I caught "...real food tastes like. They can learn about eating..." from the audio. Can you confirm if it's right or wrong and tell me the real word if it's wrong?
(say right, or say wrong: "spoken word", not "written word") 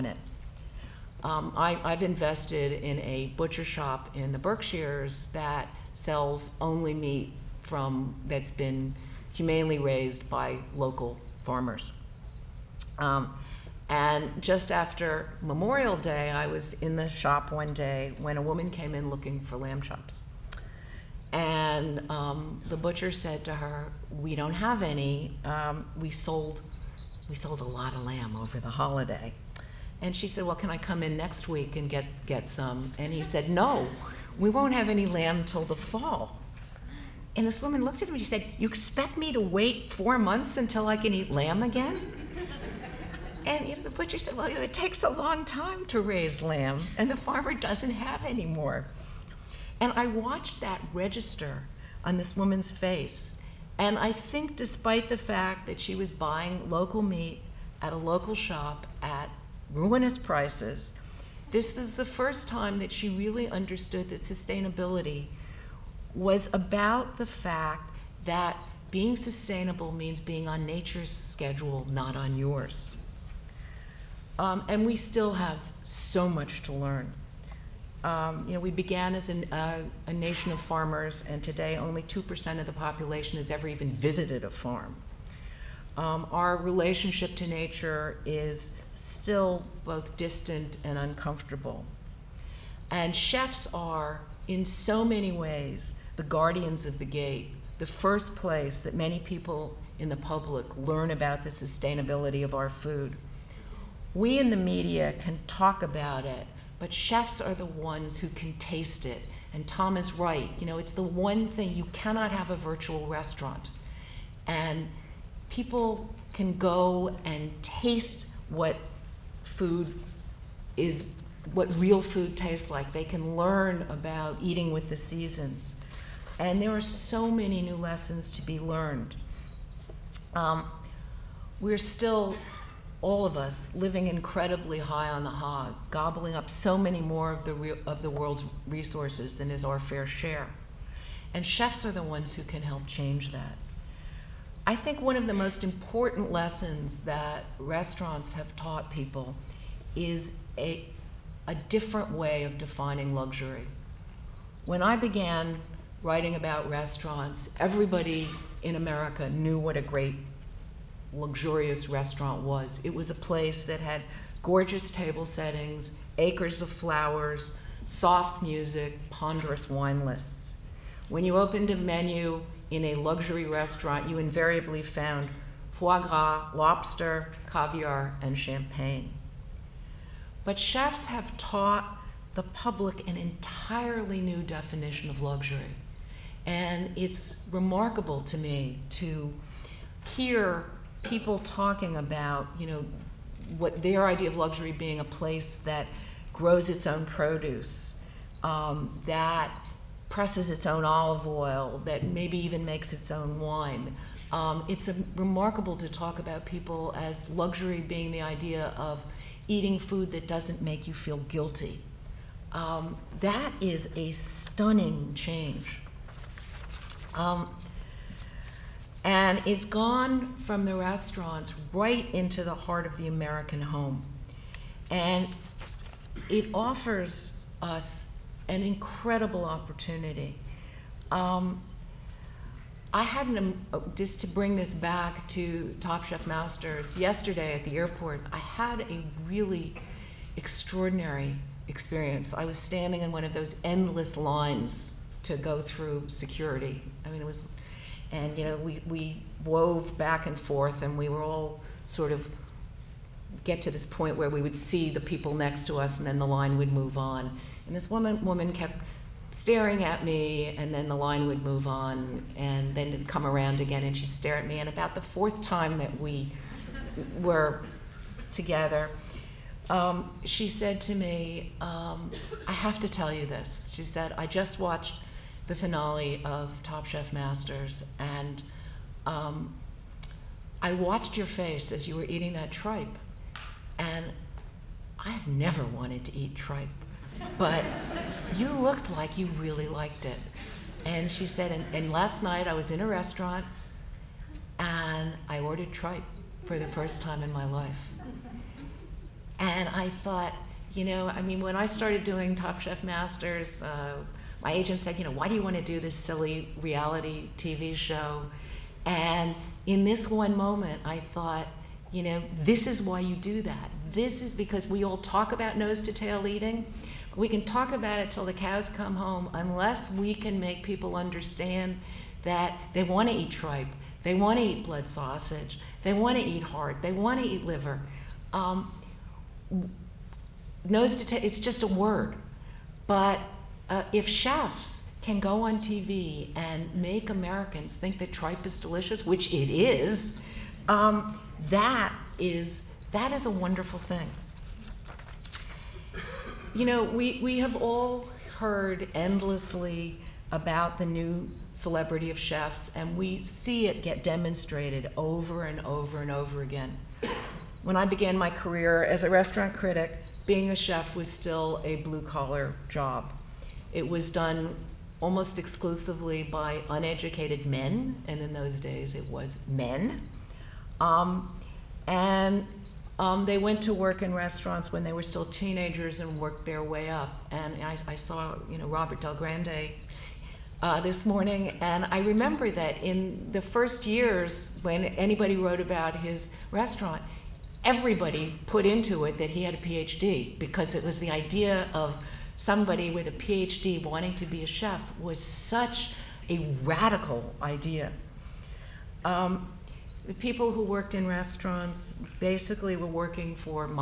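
right.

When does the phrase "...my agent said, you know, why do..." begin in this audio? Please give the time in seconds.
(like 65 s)
304 s.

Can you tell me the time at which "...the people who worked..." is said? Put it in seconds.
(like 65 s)
400 s.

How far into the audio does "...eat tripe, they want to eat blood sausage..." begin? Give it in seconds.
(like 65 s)
323 s.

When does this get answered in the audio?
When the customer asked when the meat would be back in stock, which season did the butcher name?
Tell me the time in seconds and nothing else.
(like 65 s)
35 s.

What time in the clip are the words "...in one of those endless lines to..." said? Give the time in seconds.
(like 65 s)
243 s.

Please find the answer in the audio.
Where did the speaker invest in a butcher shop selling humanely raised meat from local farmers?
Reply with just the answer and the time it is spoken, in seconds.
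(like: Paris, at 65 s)
The Berkshires, at 4 s.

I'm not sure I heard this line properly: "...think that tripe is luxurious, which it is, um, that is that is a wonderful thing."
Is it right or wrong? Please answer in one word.
wrong.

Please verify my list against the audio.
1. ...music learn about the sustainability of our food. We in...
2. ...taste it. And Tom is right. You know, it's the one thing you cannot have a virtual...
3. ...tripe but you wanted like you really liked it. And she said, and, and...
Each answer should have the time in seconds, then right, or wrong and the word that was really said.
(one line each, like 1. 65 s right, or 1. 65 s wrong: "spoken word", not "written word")
1. 100 s wrong: "public", not "music"
2. 108 s right
3. 286 s wrong: "looked", not "wanted".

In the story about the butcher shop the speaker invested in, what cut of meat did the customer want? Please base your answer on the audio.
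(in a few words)
Lamb chops.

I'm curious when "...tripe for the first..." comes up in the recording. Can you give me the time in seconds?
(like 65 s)
295 s.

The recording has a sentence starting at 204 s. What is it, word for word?
Um, it's a, remarkable to talk about people as luxury being the idea of eating food that doesn't make you feel guilty.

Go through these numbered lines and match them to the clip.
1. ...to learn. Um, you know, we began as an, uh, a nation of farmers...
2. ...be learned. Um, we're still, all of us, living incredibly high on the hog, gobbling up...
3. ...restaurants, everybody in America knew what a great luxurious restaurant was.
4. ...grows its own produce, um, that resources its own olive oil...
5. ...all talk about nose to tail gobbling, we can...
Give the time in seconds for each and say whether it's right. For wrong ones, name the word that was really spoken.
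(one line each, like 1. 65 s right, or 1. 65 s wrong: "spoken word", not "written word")
1. 76 s right
2. 128 s right
3. 156 s right
4. 196 s wrong: "presses", not "resources"
5. 314 s wrong: "eating", not "gobbling".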